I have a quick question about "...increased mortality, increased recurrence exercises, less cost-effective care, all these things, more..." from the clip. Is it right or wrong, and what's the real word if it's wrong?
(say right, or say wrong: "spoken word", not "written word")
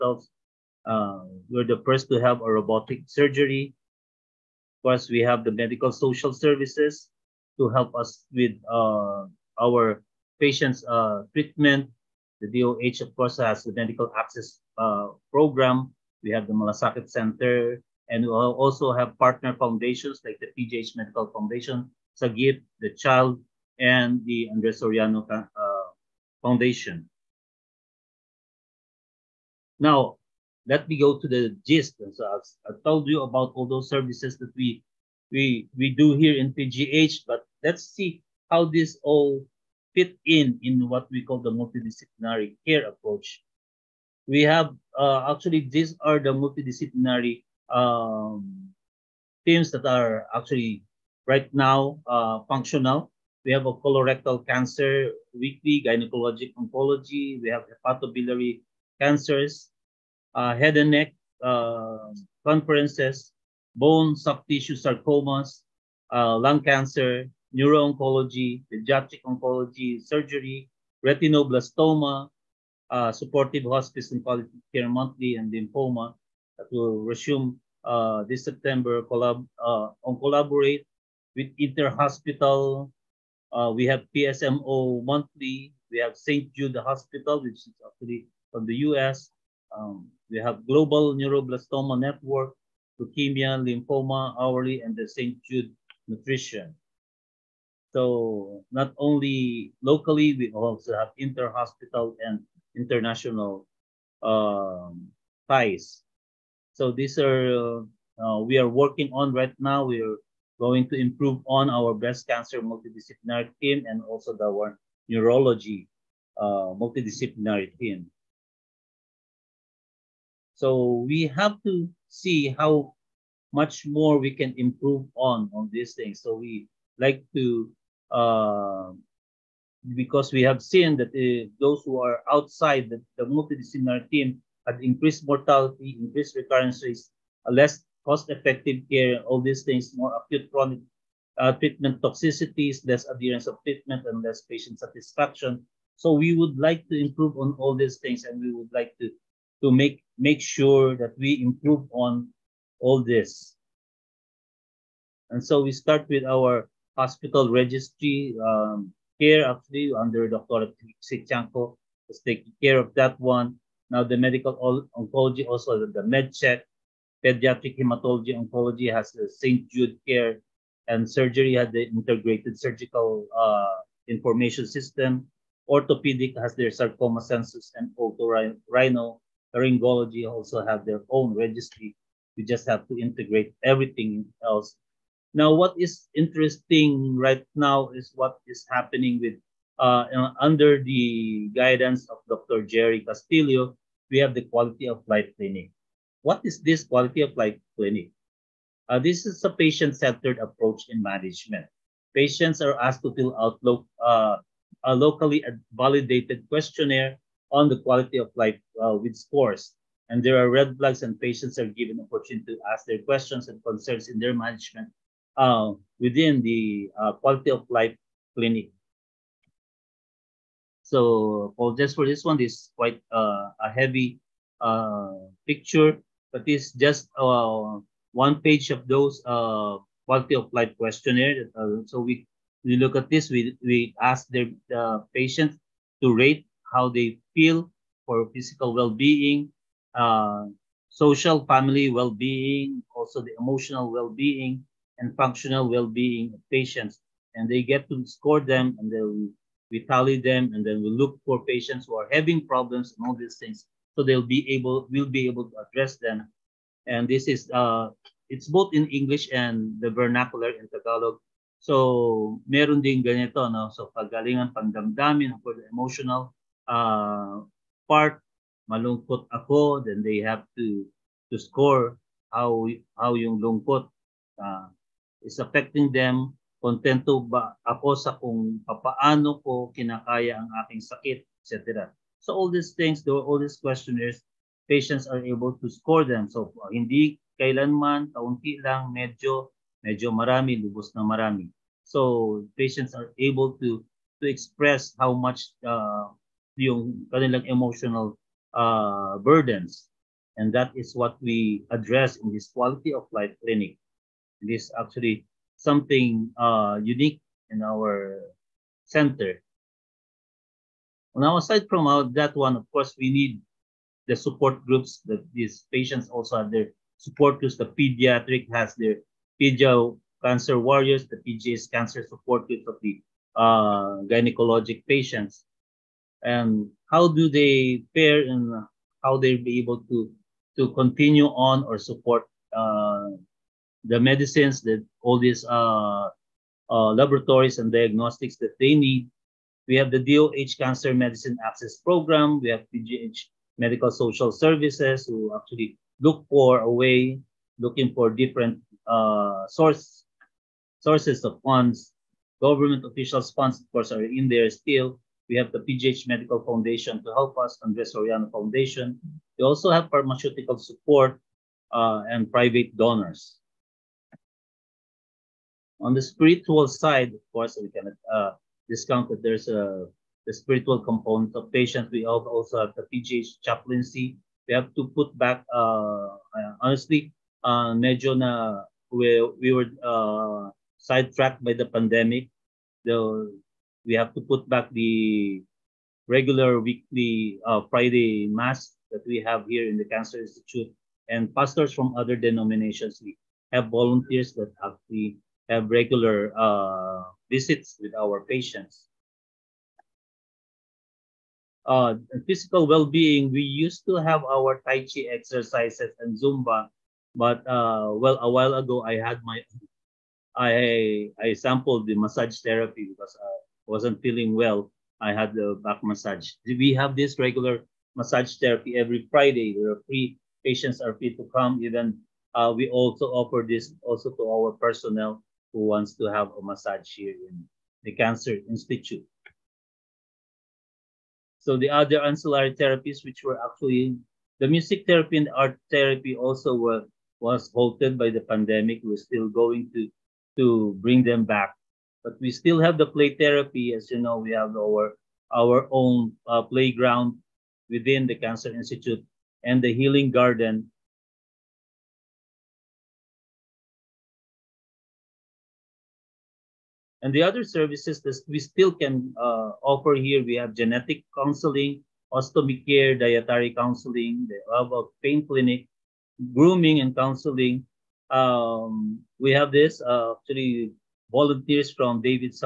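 wrong: "rates", not "exercises".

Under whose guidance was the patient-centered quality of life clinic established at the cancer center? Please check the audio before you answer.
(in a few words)
Dr. Jerry Castillo.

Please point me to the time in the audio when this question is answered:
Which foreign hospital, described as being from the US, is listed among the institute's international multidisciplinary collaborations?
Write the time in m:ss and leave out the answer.
1:26.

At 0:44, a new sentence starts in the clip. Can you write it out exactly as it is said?
We have uh, actually these are the multidisciplinary um, teams that are actually right now uh, functional.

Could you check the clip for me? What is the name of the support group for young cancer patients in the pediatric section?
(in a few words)
Pedia Cancer Warriors.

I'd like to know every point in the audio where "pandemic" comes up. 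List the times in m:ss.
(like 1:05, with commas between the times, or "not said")
6:21, 7:18.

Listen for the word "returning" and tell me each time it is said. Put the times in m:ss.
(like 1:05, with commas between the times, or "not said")
not said.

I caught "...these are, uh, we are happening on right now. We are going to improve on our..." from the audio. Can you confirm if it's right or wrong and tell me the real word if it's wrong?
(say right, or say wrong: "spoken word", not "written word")
wrong: "working", not "happening".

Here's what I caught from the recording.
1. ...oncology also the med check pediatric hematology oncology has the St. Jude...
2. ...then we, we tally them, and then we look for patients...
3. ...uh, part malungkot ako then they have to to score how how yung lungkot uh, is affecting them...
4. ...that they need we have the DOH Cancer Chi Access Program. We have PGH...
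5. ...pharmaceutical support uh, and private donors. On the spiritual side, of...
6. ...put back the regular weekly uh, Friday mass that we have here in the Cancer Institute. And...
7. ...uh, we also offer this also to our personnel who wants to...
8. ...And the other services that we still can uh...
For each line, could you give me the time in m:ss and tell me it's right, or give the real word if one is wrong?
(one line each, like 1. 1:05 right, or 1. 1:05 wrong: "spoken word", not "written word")
1. 2:44 right
2. 4:08 right
3. 4:26 right
4. 5:38 wrong: "Medicine", not "Chi"
5. 5:59 right
6. 6:24 right
7. 7:02 right
8. 7:37 right.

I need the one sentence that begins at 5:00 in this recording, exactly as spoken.
And that is what we address in this quality of life clinic.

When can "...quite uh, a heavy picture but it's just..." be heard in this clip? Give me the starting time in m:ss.
3:42.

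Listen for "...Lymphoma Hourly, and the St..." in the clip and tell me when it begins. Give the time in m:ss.
1:33.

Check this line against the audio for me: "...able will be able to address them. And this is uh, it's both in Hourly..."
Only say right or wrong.
wrong.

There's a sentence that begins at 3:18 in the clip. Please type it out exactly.
Uh, this is a patient-centered approach in management.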